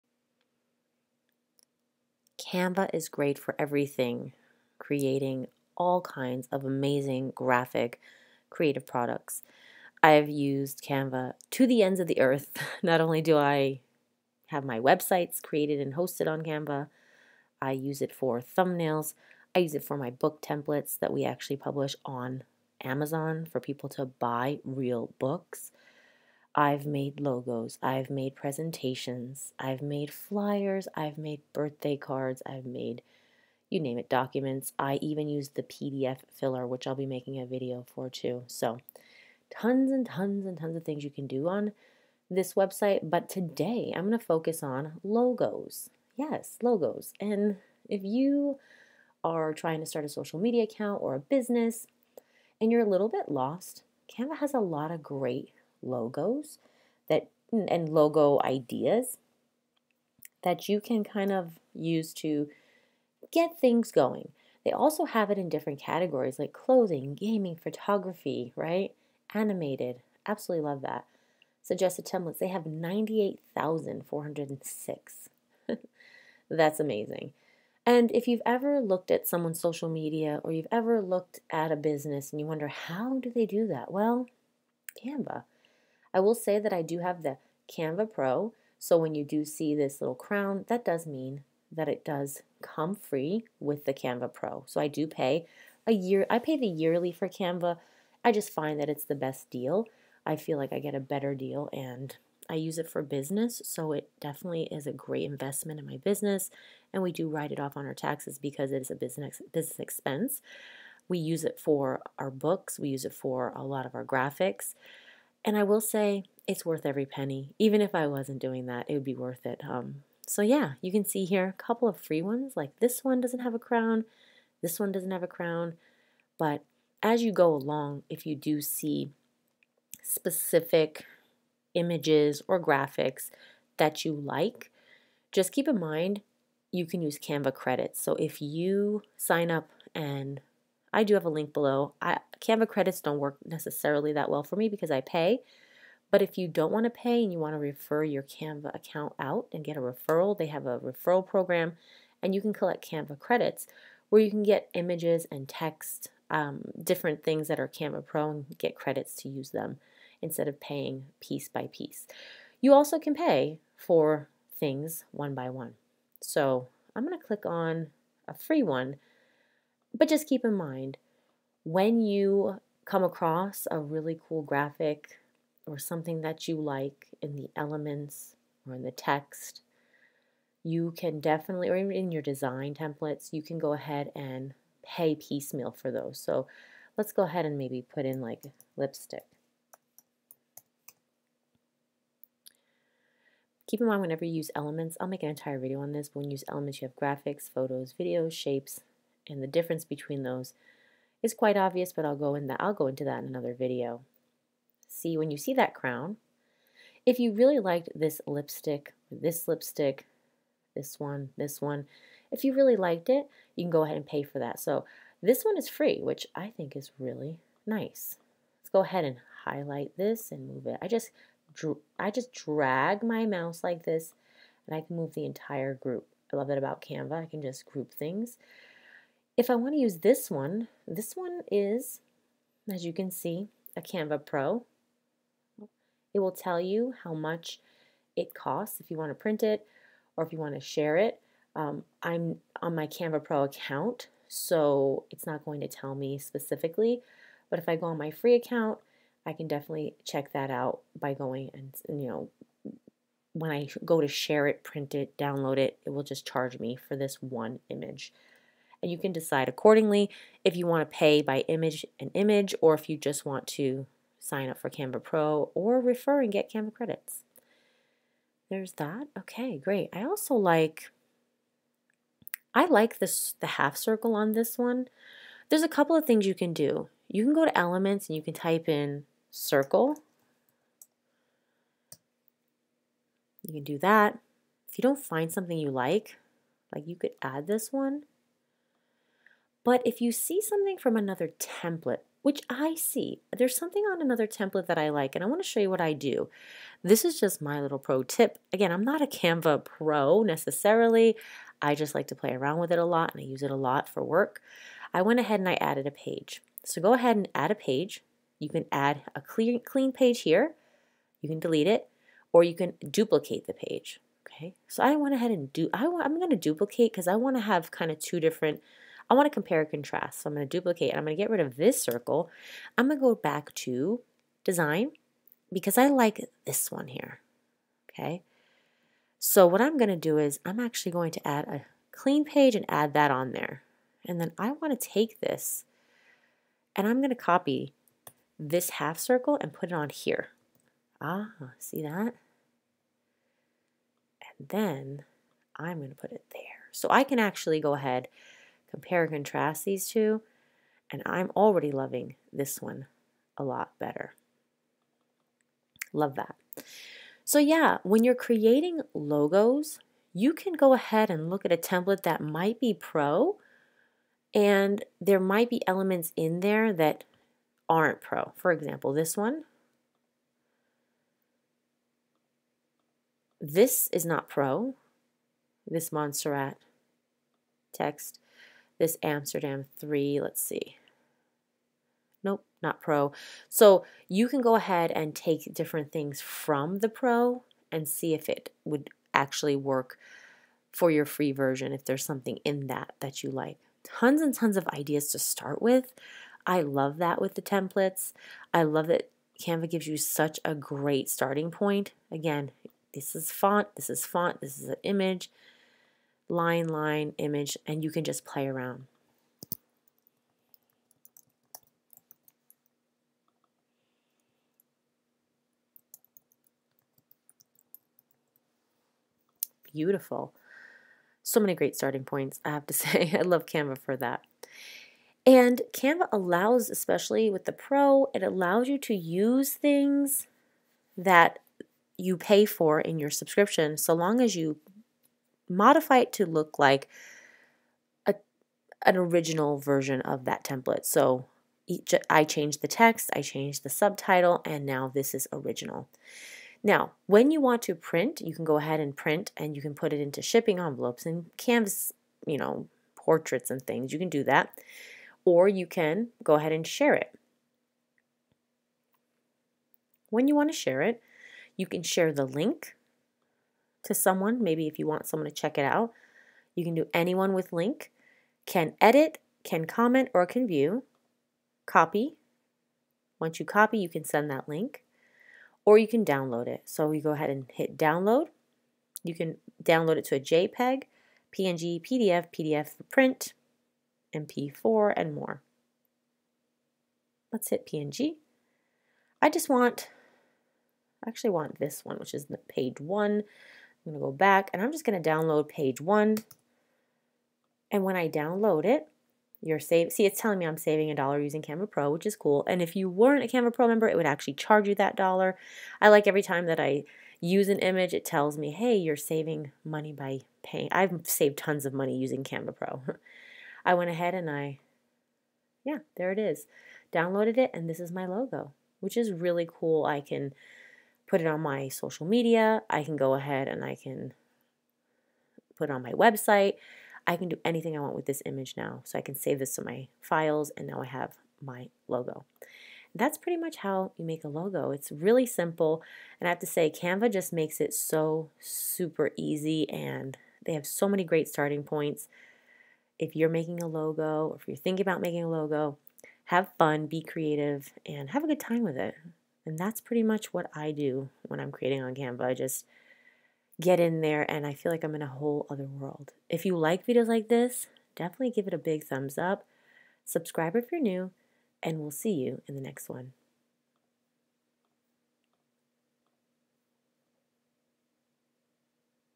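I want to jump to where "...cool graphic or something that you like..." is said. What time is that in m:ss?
2:54.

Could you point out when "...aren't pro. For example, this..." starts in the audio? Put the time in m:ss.
6:07.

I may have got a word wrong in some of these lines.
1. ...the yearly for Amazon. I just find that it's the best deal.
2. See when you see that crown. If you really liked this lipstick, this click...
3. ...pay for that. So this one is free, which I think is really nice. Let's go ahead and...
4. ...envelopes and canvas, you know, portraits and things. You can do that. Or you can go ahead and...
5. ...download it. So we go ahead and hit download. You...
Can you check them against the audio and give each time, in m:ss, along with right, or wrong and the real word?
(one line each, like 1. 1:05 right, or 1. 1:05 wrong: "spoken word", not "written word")
1. 1:36 wrong: "Canva", not "Amazon"
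2. 3:24 wrong: "lipstick", not "click"
3. 3:34 right
4. 7:30 right
5. 7:56 right.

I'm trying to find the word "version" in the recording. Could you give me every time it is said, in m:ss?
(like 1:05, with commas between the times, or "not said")
6:31, 7:19.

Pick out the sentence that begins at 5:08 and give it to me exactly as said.
You can add a clean, clean page here.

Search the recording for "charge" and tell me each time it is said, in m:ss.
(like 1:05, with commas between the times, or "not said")
4:16, 8:24.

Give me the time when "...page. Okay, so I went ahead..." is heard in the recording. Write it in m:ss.
5:13.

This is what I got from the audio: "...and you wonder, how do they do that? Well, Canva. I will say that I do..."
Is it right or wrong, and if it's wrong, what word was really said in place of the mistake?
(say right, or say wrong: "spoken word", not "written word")
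right.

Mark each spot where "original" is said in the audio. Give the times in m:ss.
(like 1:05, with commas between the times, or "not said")
7:18, 7:25.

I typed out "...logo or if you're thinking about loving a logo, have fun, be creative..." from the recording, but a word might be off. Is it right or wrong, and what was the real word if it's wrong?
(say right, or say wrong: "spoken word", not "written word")
wrong: "making", not "loving".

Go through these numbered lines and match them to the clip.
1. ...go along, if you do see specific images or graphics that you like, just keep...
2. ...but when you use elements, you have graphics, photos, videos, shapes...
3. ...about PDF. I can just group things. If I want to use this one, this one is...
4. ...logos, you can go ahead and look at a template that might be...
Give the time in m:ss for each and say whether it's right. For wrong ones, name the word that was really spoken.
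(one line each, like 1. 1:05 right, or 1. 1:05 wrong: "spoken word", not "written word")
1. 2:07 right
2. 3:16 right
3. 3:46 wrong: "Canva", not "PDF"
4. 5:58 right.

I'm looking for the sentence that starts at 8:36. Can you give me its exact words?
Downloaded it, and this is my logo, which is really cool.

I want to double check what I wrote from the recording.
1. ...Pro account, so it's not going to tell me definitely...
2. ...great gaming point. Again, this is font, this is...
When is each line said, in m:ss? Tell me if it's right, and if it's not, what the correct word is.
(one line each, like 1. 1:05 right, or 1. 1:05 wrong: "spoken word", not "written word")
1. 4:03 wrong: "specifically", not "definitely"
2. 6:40 wrong: "starting", not "gaming".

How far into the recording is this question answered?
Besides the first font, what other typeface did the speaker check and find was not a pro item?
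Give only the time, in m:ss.
6:19.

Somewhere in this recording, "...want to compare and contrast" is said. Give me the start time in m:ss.
5:19.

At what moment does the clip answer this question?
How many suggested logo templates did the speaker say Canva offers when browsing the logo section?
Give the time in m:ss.
1:12.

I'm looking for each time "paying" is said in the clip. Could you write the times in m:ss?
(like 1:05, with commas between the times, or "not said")
2:40, 8:30.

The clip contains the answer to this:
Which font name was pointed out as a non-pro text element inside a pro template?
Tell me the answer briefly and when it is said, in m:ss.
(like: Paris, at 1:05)
Montserrat, at 6:15.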